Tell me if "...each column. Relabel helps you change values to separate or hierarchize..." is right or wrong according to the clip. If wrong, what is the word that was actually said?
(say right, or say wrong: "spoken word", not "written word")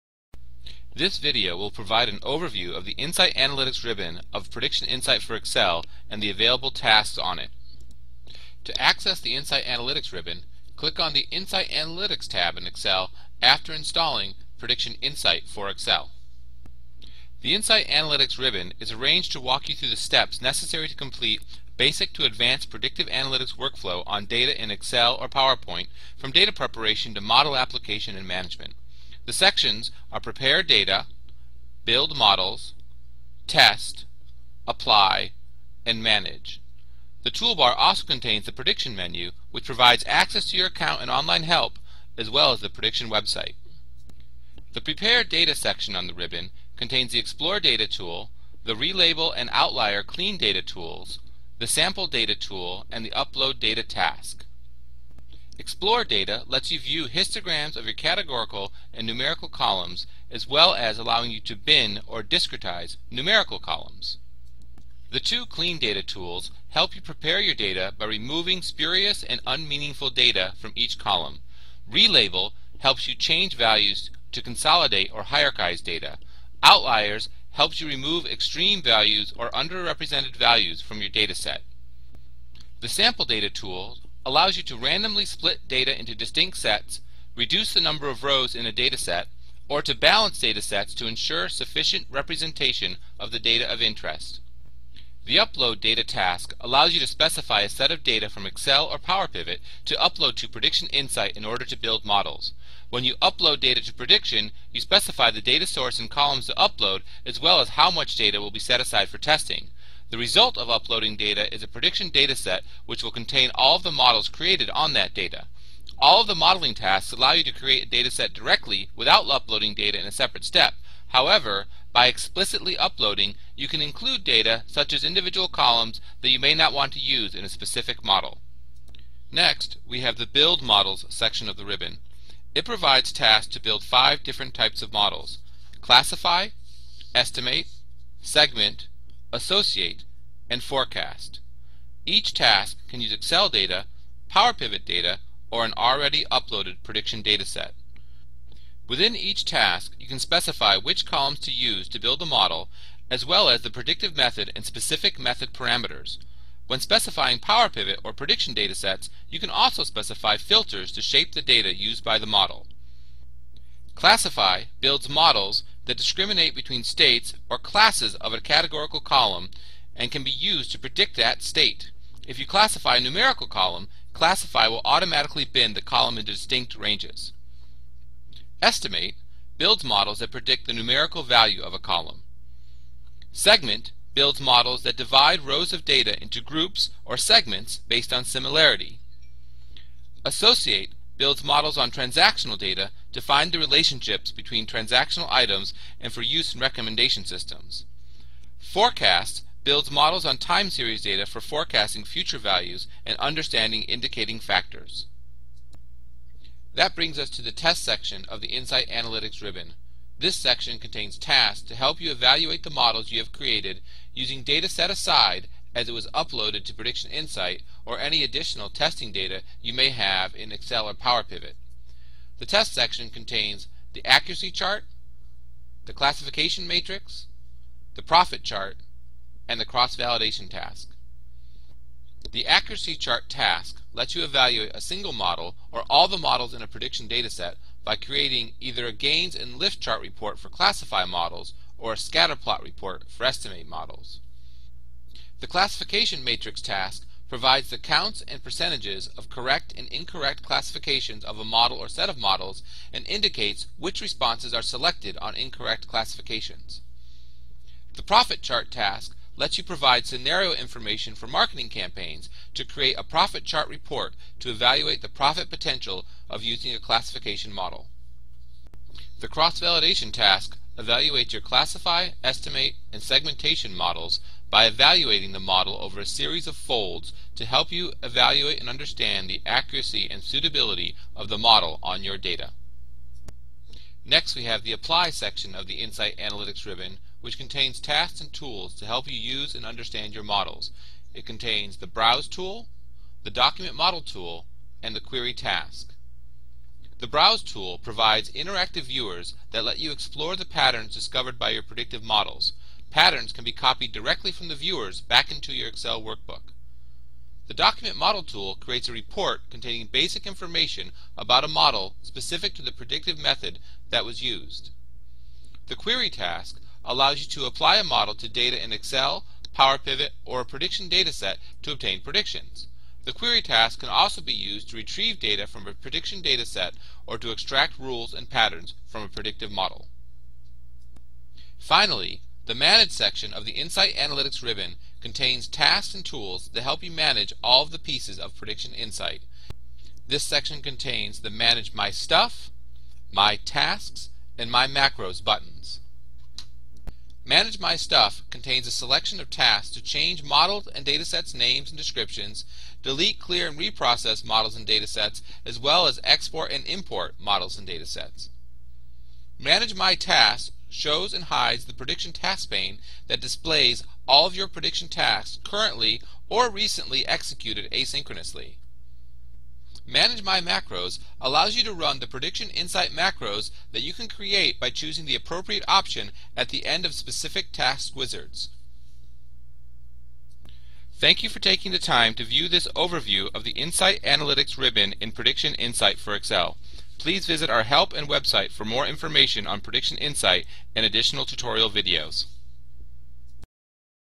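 wrong: "consolidate", not "separate".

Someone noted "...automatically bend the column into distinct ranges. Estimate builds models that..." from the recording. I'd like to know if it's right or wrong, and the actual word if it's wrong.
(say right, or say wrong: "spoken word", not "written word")
right.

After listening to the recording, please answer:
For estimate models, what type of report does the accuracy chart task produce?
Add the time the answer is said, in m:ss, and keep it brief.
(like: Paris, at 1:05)
Scatter plot report, at 4:01.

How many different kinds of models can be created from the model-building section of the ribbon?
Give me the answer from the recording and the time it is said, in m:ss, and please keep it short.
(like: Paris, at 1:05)
5, at 2:13.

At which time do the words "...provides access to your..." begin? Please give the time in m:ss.
0:39.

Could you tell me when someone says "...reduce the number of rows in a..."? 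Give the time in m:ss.
1:27.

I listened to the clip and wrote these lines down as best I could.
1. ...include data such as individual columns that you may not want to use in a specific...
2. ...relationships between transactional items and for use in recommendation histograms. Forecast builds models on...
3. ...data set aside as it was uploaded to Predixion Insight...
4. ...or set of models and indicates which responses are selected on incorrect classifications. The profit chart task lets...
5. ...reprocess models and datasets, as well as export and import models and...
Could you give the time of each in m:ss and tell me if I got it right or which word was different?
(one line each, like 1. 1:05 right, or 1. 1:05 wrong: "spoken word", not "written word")
1. 2:03 right
2. 3:13 wrong: "systems", not "histograms"
3. 3:34 right
4. 4:11 right
5. 5:53 right.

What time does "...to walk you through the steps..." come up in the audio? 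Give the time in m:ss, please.
0:19.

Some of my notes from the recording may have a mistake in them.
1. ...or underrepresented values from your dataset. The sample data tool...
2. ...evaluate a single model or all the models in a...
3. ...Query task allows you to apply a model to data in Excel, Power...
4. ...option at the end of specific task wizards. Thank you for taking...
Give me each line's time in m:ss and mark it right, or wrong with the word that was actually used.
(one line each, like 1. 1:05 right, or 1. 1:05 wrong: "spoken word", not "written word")
1. 1:19 right
2. 3:54 right
3. 5:15 right
4. 6:15 right.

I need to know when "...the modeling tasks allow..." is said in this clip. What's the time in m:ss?
1:56.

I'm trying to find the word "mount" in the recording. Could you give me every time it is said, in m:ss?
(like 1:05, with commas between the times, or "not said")
not said.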